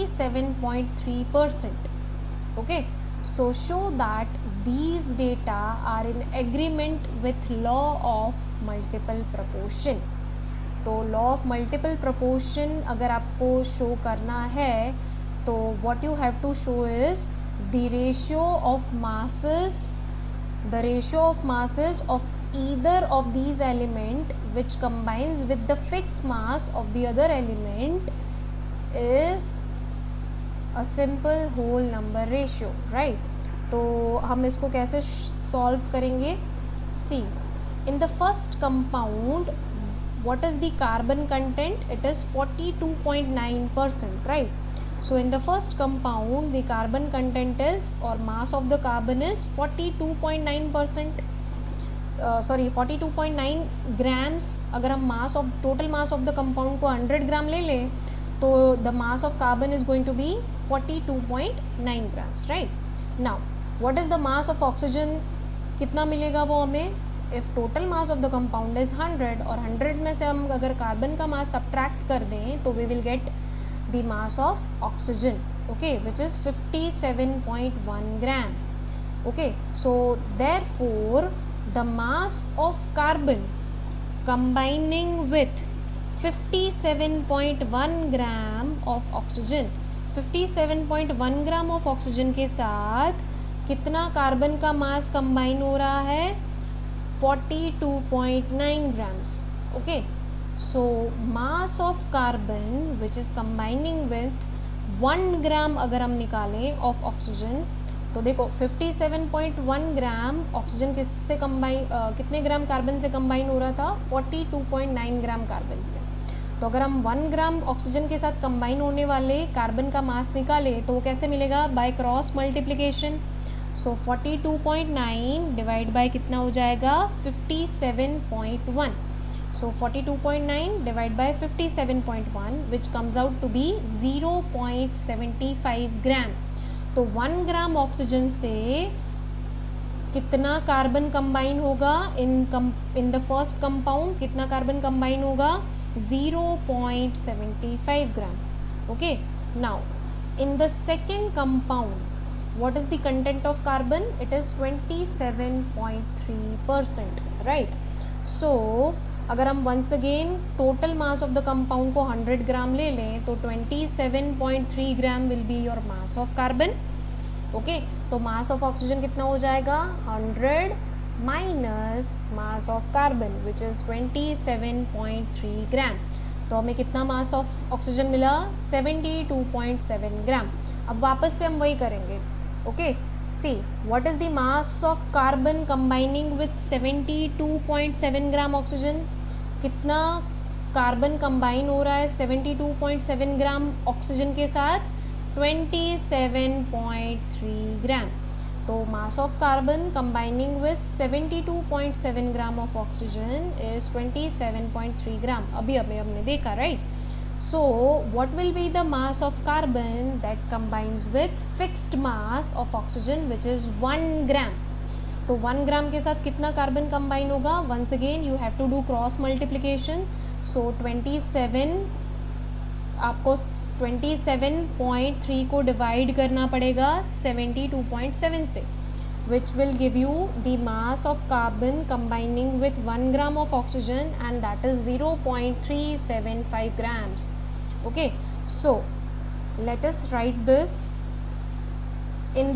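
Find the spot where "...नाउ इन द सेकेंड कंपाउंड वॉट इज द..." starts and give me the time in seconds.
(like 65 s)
149 s.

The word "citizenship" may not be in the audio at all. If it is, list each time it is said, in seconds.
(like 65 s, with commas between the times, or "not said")
not said.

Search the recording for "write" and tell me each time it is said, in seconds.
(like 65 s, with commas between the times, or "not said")
240 s.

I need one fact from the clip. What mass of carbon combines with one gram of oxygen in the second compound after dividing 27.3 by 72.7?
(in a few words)
0.375 grams.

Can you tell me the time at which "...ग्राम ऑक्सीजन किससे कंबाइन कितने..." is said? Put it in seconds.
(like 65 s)
109 s.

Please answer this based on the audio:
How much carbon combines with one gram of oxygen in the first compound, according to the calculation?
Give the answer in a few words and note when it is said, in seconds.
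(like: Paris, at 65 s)
0.75 grams, at 133 s.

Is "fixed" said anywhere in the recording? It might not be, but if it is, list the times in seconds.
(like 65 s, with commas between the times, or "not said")
211 s.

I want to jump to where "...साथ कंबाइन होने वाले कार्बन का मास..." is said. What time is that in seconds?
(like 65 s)
118 s.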